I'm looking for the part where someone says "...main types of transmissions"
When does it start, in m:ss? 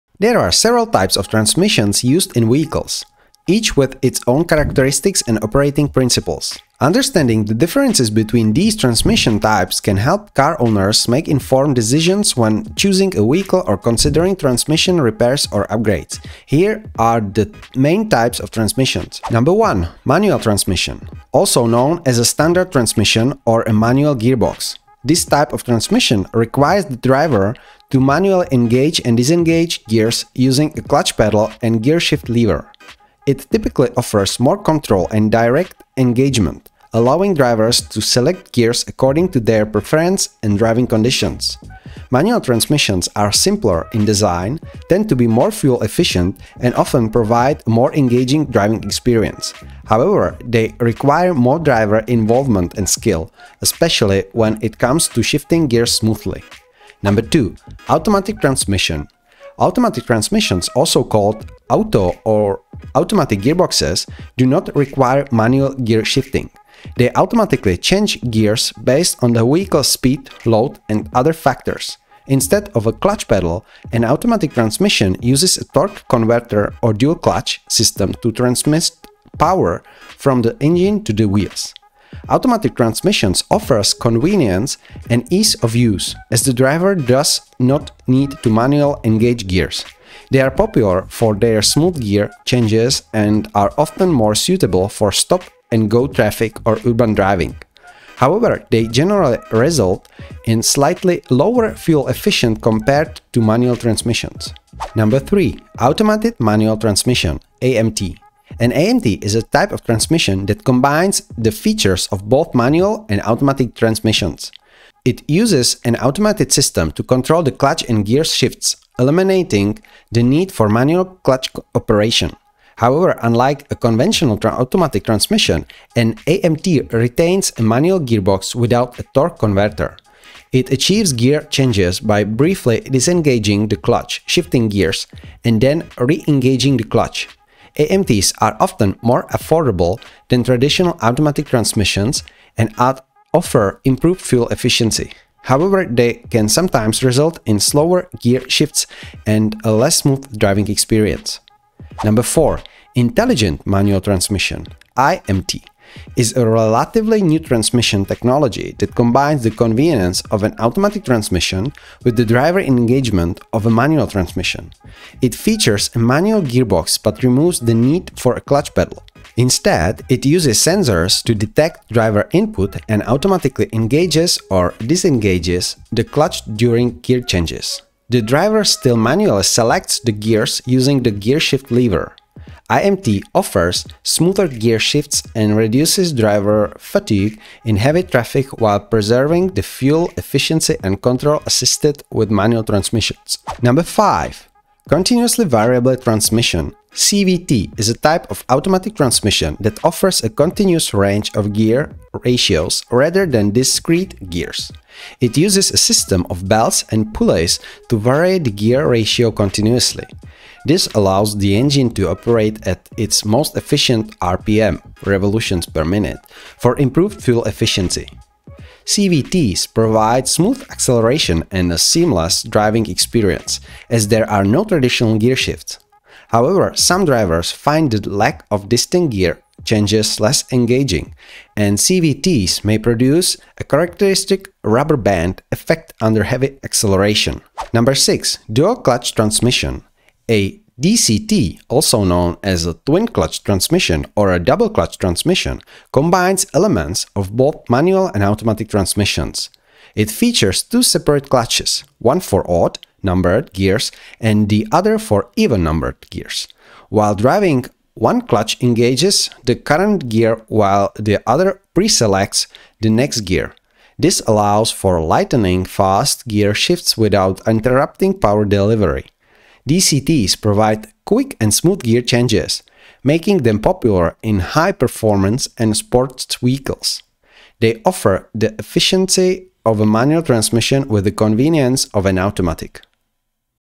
0:17.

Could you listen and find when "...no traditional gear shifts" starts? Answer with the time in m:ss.
3:44.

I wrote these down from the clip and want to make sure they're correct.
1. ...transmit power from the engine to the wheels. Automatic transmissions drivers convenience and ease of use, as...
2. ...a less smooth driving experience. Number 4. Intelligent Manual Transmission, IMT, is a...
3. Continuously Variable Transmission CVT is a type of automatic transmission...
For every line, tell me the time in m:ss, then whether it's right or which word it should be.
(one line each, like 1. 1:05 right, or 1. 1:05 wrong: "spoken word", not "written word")
1. 1:18 wrong: "offers", not "drivers"
2. 2:29 right
3. 3:14 right.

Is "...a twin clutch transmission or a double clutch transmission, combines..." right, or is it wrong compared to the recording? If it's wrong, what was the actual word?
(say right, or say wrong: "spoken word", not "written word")
right.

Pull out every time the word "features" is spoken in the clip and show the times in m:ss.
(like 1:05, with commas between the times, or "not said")
1:51, 2:45, 4:10.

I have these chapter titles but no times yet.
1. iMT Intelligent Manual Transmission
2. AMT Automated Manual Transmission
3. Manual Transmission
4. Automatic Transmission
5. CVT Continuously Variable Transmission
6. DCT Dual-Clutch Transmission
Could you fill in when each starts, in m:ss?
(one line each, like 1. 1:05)
1. 2:32
2. 1:44
3. 0:19
4. 0:56
5. 3:13
6. 3:57.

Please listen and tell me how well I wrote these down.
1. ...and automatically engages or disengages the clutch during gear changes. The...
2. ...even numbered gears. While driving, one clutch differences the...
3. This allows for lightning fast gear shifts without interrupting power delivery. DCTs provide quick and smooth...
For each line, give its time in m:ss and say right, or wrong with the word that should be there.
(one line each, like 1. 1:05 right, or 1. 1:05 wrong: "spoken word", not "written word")
1. 2:52 right
2. 4:15 wrong: "engages", not "differences"
3. 4:23 right.